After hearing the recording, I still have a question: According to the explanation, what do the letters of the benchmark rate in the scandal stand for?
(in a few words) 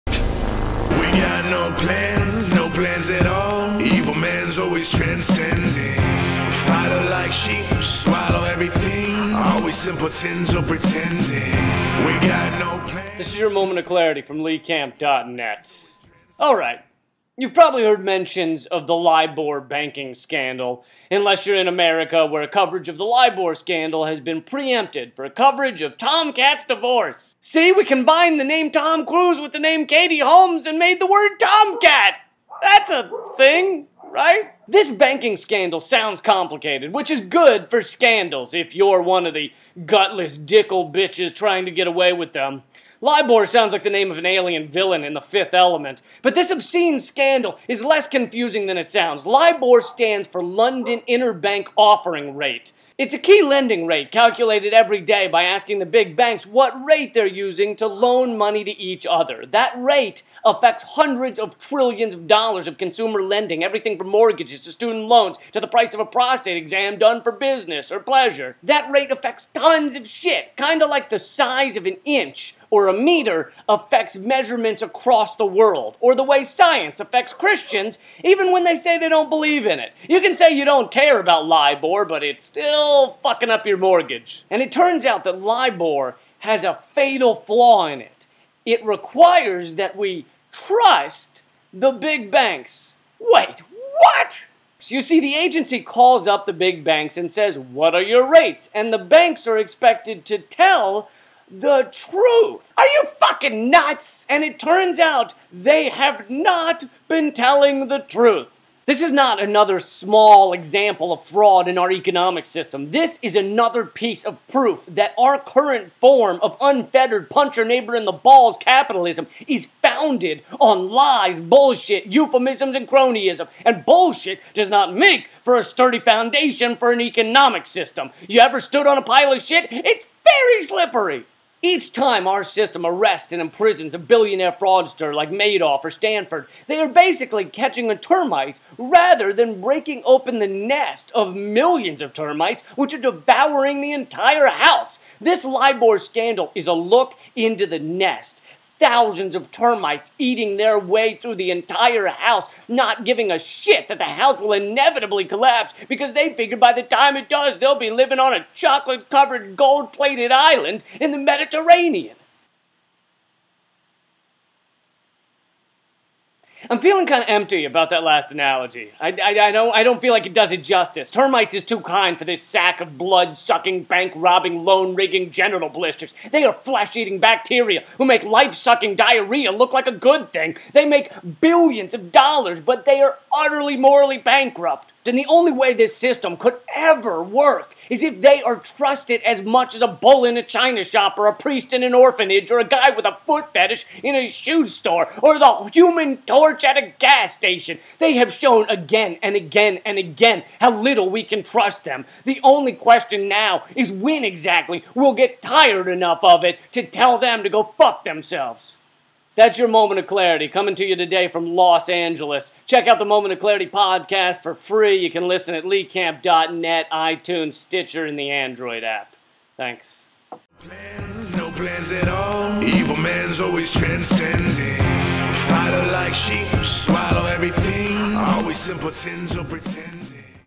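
London Interbank Offering Rate.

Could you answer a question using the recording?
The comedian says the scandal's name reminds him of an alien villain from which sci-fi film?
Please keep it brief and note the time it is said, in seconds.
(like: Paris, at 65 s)
The Fifth Element, at 45 s.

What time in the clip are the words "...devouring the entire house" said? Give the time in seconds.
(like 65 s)
142 s.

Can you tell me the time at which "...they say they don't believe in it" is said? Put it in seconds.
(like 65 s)
78 s.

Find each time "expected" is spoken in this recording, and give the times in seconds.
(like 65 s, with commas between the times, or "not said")
99 s.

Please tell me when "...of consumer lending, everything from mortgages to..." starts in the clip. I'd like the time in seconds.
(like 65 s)
62 s.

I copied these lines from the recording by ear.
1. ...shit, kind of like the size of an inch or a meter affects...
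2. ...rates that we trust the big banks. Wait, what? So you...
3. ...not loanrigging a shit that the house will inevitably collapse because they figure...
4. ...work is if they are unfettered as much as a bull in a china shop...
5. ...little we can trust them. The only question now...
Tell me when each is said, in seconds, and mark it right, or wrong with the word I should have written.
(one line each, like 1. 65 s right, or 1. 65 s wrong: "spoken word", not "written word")
1. 70 s right
2. 88 s wrong: "requires", not "rates"
3. 152 s wrong: "giving", not "loanrigging"
4. 187 s wrong: "trusted", not "unfettered"
5. 200 s right.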